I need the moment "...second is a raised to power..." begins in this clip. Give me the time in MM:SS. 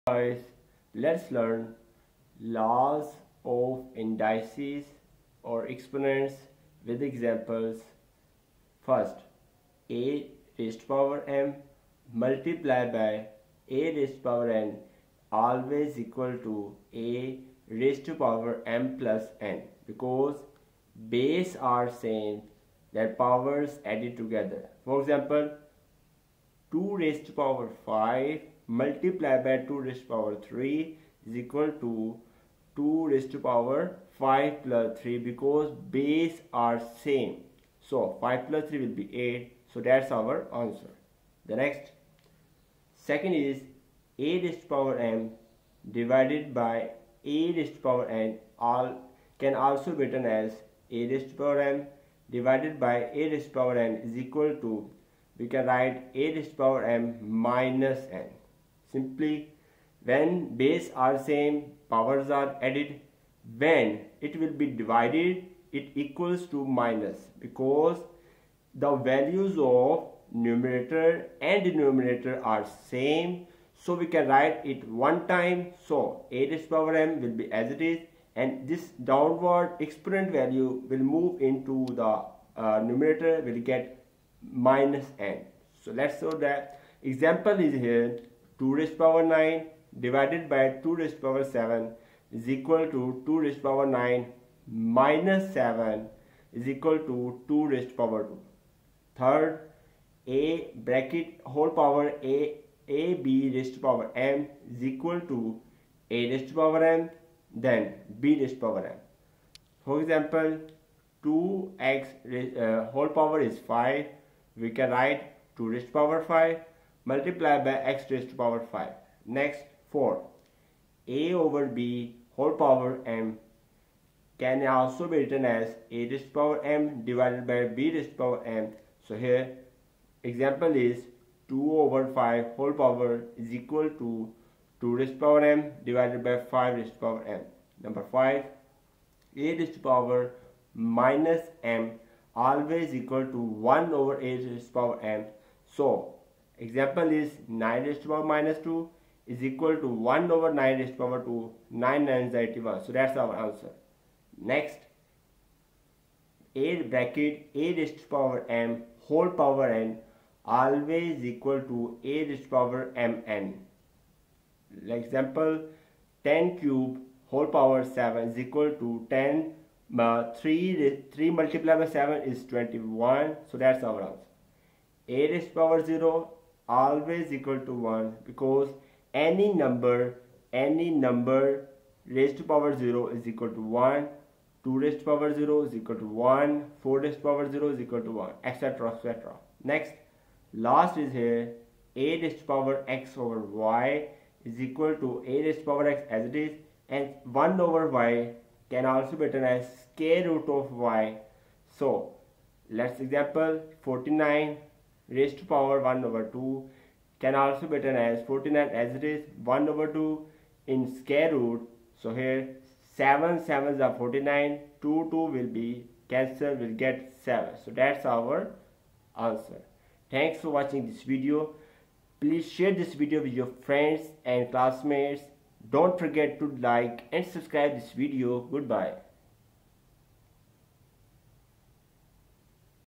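00:43.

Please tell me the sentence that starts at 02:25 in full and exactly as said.
So Example is 9 raised to power minus 2 is equal to 1 over 9 raised to power 2, 9 nines 81.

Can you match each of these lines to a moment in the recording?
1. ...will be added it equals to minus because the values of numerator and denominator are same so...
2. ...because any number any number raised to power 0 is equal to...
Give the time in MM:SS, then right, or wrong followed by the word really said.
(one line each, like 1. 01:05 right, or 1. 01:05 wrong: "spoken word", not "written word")
1. 01:04 wrong: "divided", not "added"
2. 02:58 right.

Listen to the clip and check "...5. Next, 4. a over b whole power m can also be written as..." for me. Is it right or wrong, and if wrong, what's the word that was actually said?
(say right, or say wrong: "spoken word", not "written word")
right.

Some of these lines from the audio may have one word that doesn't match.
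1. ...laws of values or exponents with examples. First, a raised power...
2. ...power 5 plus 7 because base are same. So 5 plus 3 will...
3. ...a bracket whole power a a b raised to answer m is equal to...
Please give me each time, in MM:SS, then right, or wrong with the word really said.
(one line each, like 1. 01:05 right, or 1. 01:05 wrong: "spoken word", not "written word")
1. 00:02 wrong: "indices", not "values"
2. 00:33 wrong: "3", not "7"
3. 01:40 wrong: "power", not "answer".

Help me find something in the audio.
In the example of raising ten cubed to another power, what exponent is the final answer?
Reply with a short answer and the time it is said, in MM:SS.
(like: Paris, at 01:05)
21, at 02:52.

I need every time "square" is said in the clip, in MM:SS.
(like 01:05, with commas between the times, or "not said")
03:19, 03:30.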